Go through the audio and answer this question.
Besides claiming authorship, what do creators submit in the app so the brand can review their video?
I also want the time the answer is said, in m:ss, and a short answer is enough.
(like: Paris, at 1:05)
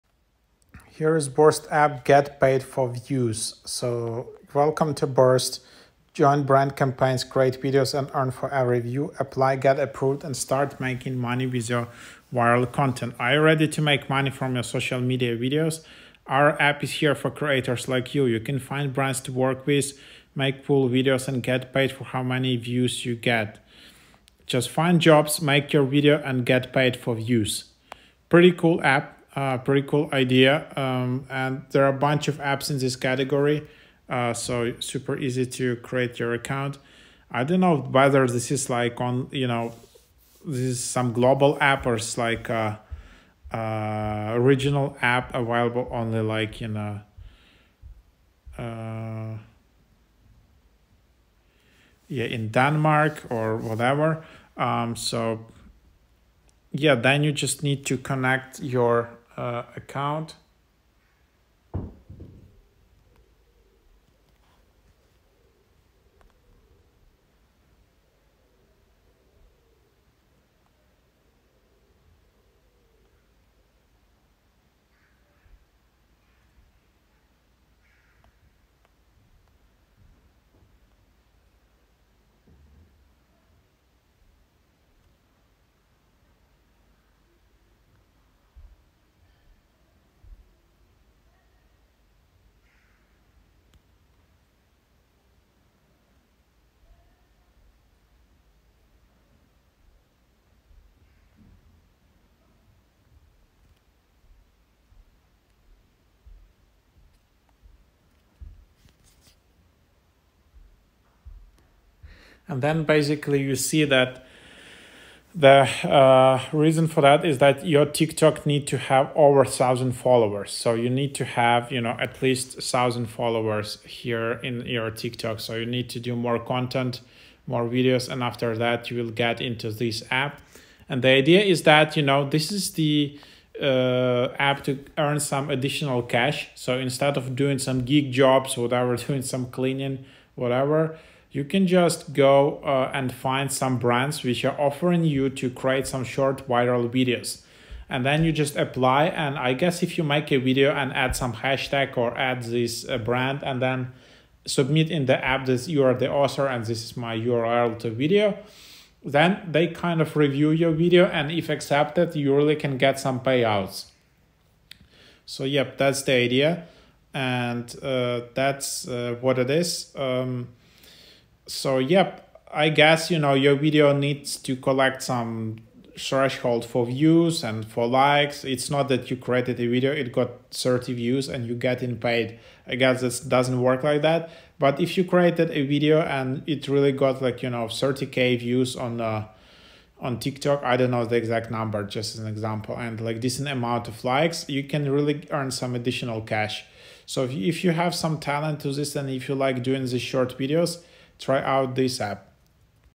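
URL, at 2:37.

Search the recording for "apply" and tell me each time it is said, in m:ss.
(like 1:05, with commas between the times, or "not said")
0:09, 2:28.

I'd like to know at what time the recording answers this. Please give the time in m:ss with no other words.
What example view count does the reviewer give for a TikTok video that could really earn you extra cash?
3:07.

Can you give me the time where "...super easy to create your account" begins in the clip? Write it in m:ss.
0:34.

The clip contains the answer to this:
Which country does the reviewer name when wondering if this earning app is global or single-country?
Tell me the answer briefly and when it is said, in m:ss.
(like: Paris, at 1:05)
Denmark, at 0:52.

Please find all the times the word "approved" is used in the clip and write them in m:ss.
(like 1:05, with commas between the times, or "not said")
0:09.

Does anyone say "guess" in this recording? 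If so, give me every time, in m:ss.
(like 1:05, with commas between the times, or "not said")
2:29, 2:52, 3:02.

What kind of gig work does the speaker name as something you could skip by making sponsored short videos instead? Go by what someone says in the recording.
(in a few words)
Cleaning.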